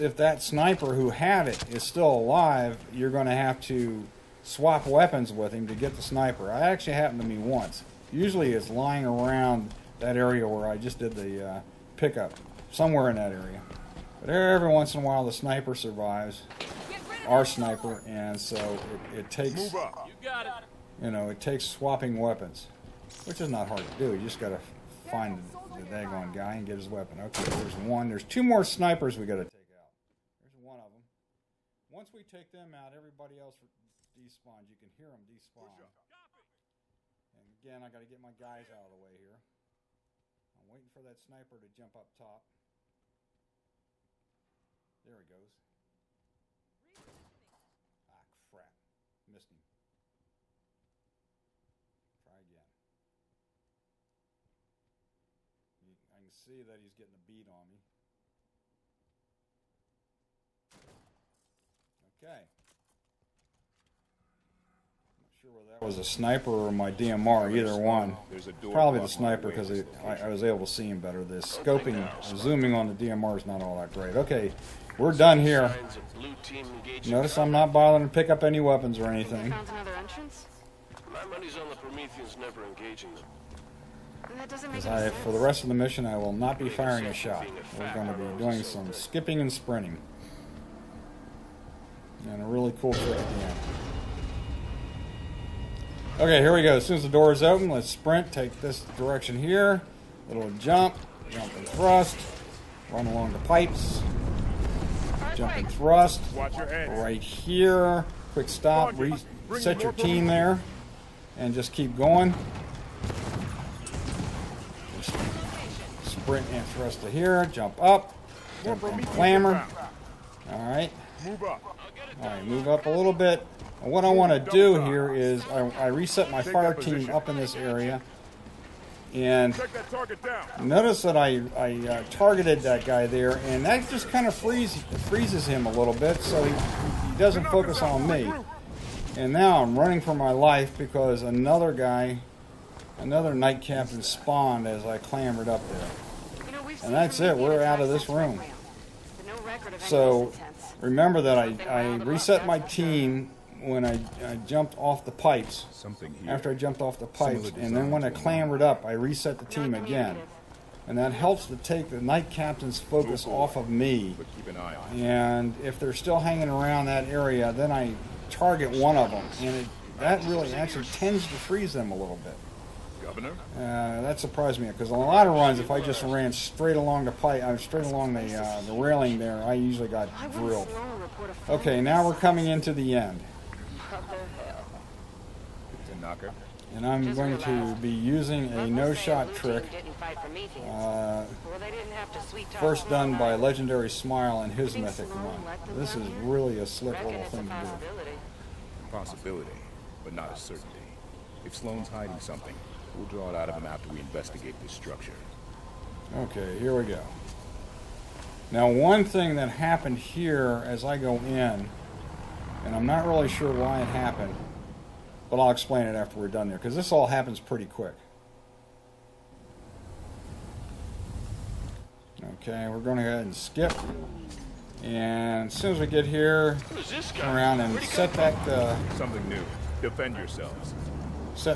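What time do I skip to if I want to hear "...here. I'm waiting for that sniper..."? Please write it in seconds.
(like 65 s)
39 s.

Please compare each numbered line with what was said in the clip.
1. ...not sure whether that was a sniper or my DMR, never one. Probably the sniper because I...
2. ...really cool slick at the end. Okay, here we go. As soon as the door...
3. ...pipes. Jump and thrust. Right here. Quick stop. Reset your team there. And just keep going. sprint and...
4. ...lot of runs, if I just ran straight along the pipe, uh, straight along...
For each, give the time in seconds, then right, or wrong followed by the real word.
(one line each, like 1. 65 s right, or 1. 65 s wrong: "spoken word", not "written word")
1. 65 s wrong: "either", not "never"
2. 92 s wrong: "trick", not "slick"
3. 103 s right
4. 174 s right.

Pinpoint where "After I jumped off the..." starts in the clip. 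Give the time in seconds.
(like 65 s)
156 s.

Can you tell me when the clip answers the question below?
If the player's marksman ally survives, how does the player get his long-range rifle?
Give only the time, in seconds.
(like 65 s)
21 s.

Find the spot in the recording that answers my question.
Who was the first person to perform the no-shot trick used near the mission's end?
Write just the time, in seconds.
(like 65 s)
193 s.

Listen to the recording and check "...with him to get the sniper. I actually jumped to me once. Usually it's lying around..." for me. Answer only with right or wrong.
wrong.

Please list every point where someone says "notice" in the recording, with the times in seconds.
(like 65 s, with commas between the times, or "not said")
77 s, 130 s.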